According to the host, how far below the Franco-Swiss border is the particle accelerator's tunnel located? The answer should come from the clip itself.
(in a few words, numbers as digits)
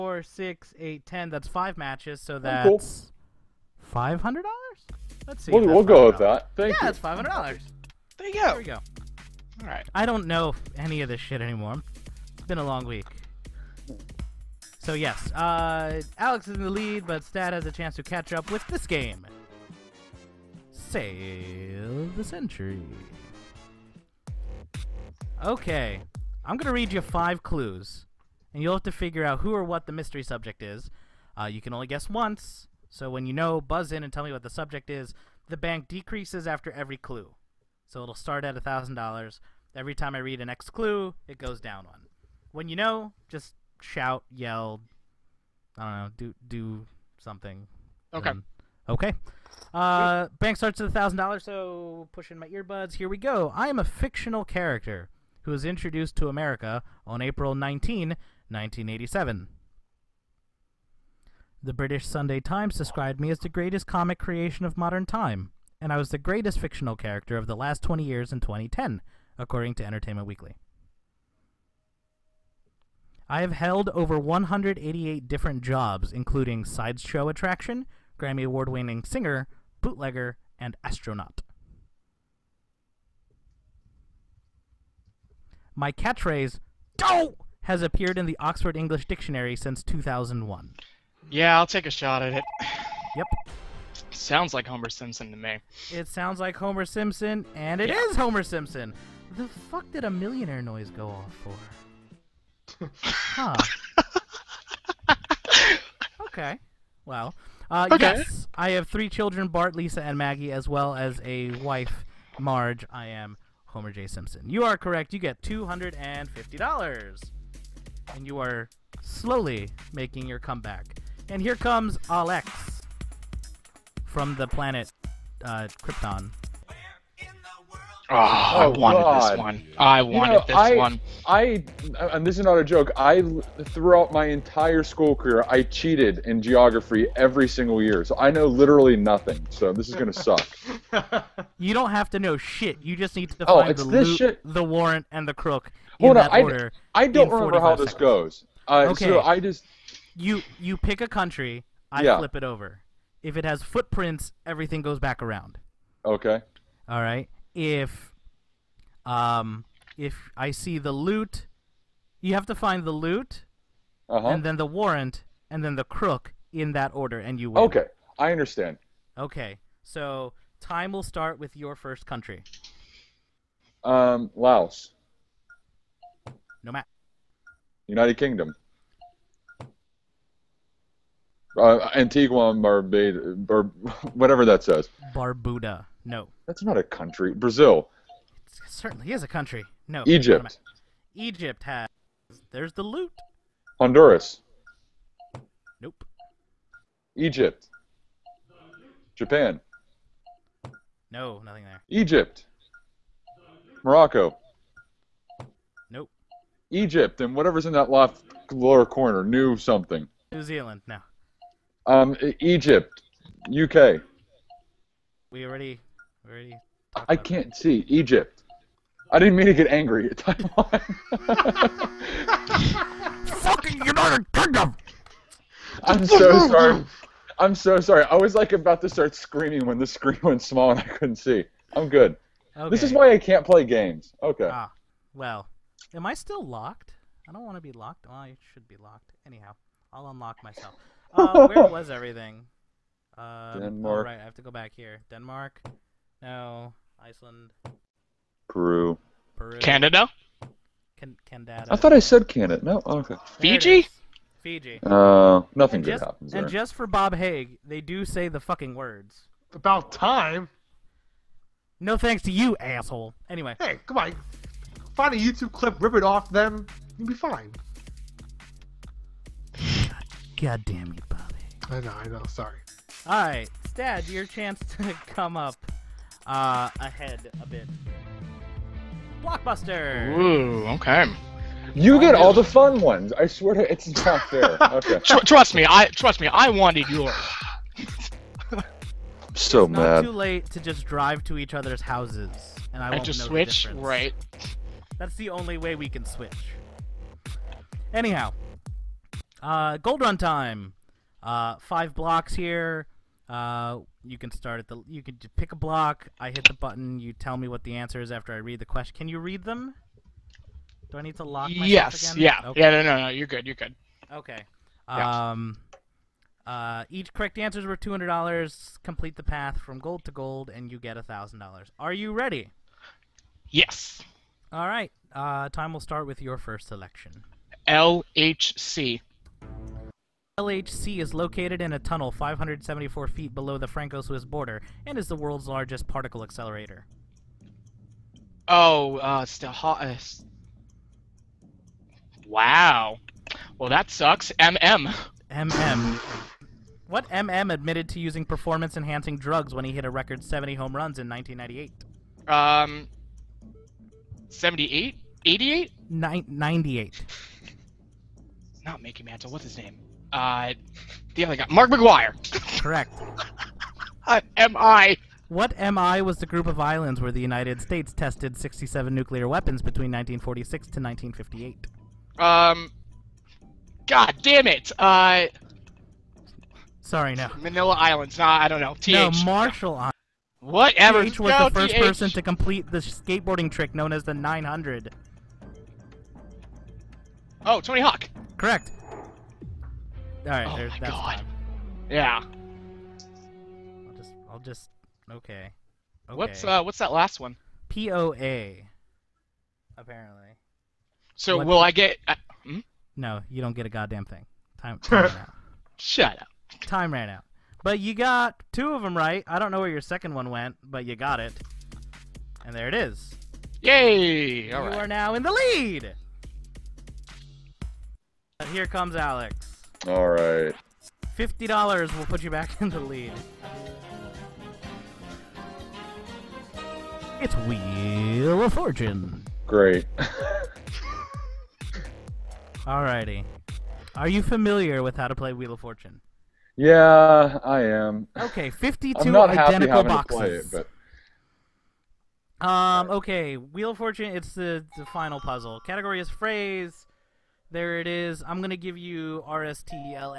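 574 feet.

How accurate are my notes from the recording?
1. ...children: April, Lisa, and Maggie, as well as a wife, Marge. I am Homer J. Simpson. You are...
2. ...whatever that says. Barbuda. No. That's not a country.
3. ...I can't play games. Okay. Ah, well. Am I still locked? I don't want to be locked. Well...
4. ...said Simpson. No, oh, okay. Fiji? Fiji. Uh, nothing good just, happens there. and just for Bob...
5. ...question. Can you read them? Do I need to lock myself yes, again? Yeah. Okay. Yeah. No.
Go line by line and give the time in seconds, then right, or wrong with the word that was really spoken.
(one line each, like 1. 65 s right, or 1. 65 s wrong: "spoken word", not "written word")
1. 109 s wrong: "Bart", not "April"
2. 184 s right
3. 233 s right
4. 251 s wrong: "Canada", not "Simpson"
5. 308 s right.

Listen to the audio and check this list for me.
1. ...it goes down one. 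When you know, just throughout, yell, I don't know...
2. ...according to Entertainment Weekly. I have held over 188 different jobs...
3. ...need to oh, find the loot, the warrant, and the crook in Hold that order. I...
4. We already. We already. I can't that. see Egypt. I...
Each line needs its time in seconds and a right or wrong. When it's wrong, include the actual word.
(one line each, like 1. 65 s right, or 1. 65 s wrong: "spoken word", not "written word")
1. 41 s wrong: "shout", not "throughout"
2. 69 s right
3. 143 s right
4. 215 s right.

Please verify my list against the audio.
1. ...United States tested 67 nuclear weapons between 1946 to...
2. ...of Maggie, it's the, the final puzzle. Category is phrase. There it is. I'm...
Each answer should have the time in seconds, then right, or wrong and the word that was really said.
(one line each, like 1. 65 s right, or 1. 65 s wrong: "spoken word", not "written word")
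1. 367 s right
2. 443 s wrong: "Fortune", not "Maggie".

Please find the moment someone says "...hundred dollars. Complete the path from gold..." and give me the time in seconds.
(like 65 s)
317 s.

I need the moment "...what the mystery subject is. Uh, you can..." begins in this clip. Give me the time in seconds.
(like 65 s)
29 s.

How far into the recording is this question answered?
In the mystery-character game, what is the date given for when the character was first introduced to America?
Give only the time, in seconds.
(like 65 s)
57 s.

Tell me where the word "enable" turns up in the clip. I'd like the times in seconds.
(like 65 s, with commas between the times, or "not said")
not said.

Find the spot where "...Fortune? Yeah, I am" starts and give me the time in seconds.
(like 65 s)
435 s.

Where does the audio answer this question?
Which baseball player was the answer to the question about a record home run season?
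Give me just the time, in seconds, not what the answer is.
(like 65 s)
361 s.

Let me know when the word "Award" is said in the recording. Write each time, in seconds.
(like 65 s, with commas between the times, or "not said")
78 s.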